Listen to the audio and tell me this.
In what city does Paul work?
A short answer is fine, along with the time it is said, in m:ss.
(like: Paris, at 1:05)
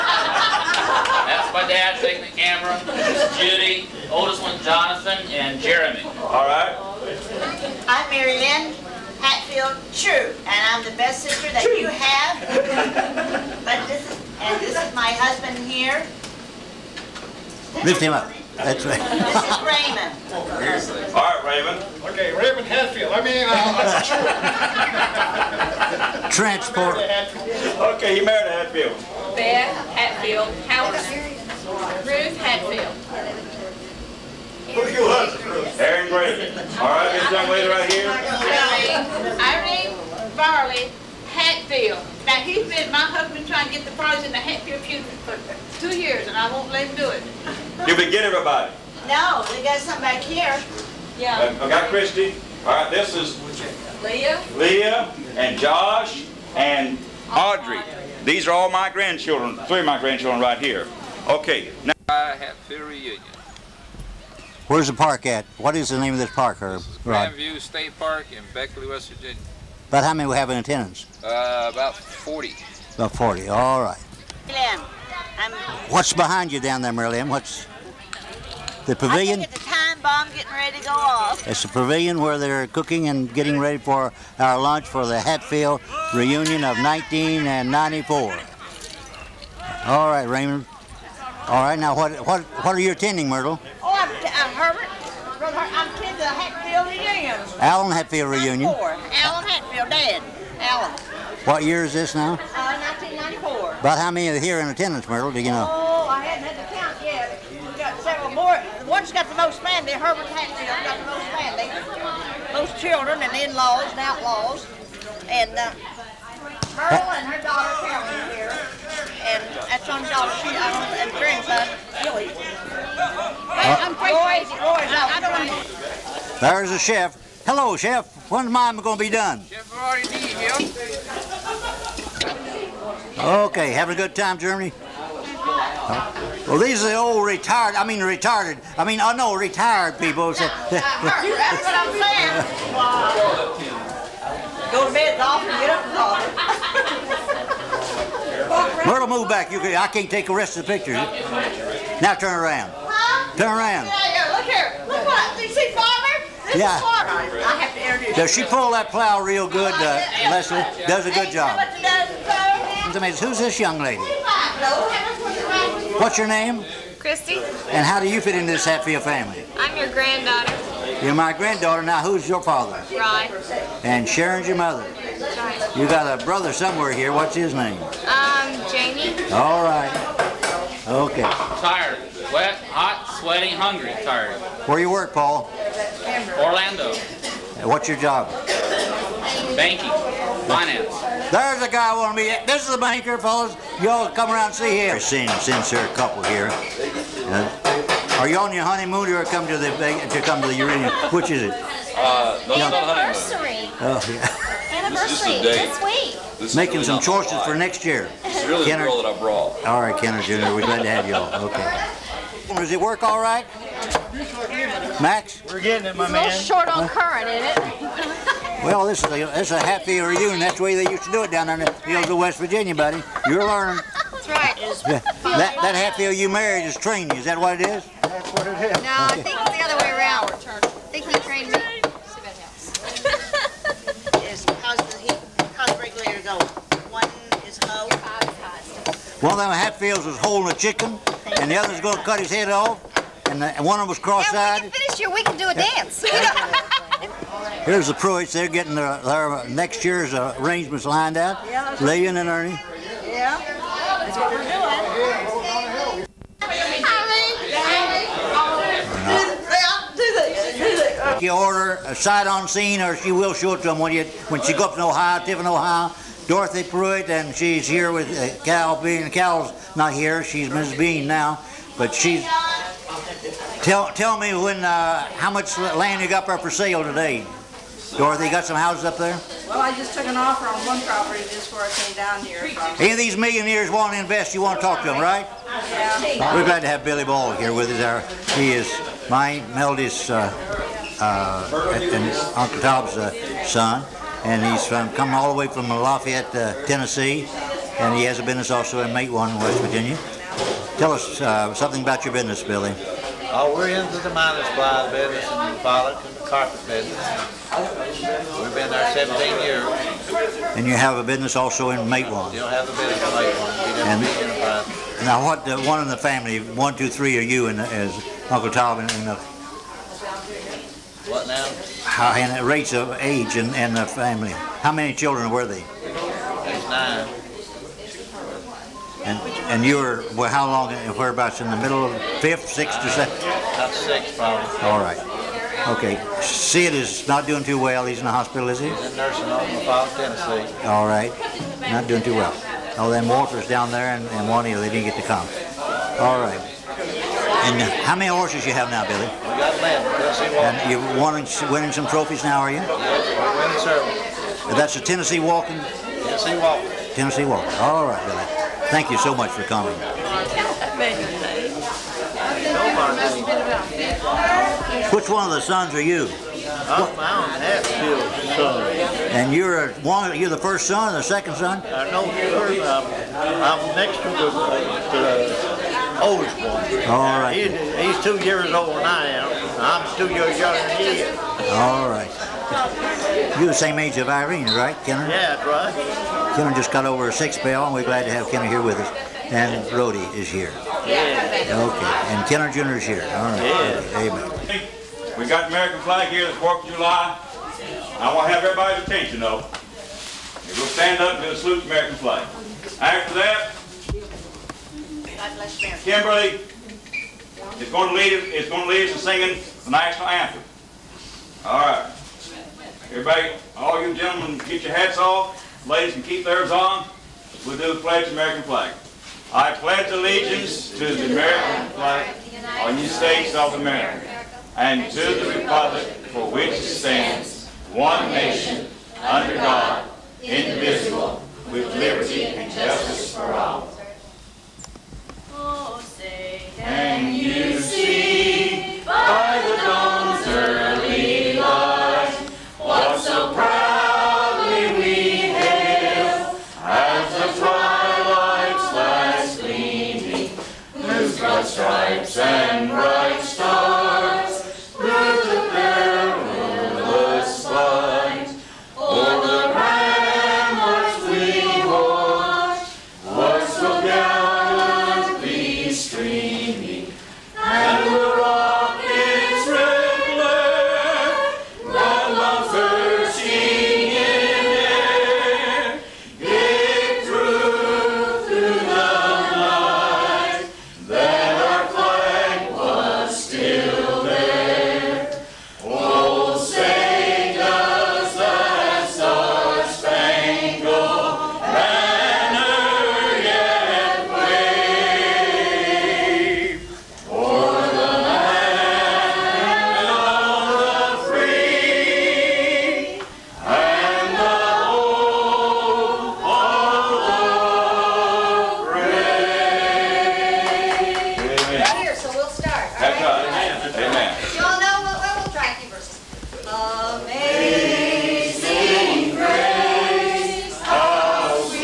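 Orlando, at 3:06.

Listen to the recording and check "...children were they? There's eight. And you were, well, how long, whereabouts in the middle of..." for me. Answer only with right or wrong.
wrong.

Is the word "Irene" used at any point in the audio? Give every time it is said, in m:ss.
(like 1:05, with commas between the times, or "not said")
0:39, 6:24.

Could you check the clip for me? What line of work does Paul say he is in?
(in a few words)
Banking.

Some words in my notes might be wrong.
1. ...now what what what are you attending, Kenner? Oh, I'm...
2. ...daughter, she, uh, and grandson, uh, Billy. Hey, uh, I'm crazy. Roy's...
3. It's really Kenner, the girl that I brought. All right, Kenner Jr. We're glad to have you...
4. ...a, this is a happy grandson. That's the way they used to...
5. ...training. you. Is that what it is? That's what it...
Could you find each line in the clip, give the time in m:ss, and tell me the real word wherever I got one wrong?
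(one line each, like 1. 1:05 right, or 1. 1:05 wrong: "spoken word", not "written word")
1. 1:31 wrong: "Myrtle", not "Kenner"
2. 2:00 right
3. 3:28 right
4. 3:39 wrong: "reunion", not "grandson"
5. 3:46 right.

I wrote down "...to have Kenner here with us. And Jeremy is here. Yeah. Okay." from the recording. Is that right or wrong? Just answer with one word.
wrong.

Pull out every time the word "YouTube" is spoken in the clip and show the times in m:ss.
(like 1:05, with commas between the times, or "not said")
not said.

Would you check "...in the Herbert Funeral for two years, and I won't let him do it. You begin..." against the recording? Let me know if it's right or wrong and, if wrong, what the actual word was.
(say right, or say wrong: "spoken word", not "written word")
wrong: "Hatfield", not "Herbert".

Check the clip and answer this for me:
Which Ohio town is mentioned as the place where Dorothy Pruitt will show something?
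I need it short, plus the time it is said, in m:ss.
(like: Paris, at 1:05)
Tiffin, at 4:25.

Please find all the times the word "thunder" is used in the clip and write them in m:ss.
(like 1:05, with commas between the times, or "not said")
not said.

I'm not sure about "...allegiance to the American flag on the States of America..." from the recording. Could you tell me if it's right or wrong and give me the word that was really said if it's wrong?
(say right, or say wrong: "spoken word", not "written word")
right.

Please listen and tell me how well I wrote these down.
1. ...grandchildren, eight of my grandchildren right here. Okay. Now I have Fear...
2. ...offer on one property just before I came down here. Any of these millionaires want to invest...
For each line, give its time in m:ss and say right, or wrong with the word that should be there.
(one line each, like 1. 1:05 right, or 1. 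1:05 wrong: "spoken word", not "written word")
1. 0:58 wrong: "three", not "eight"
2. 4:40 right.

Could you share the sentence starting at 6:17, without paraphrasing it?
He's, he's, two years older than I am.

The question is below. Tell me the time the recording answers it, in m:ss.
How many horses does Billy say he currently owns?
5:49.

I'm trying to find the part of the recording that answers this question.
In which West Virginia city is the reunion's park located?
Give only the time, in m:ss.
1:08.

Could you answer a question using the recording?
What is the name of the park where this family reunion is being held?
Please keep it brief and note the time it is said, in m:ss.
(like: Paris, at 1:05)
Grandview State Park, at 1:07.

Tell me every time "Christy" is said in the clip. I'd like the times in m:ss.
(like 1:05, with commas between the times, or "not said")
0:51, 2:46.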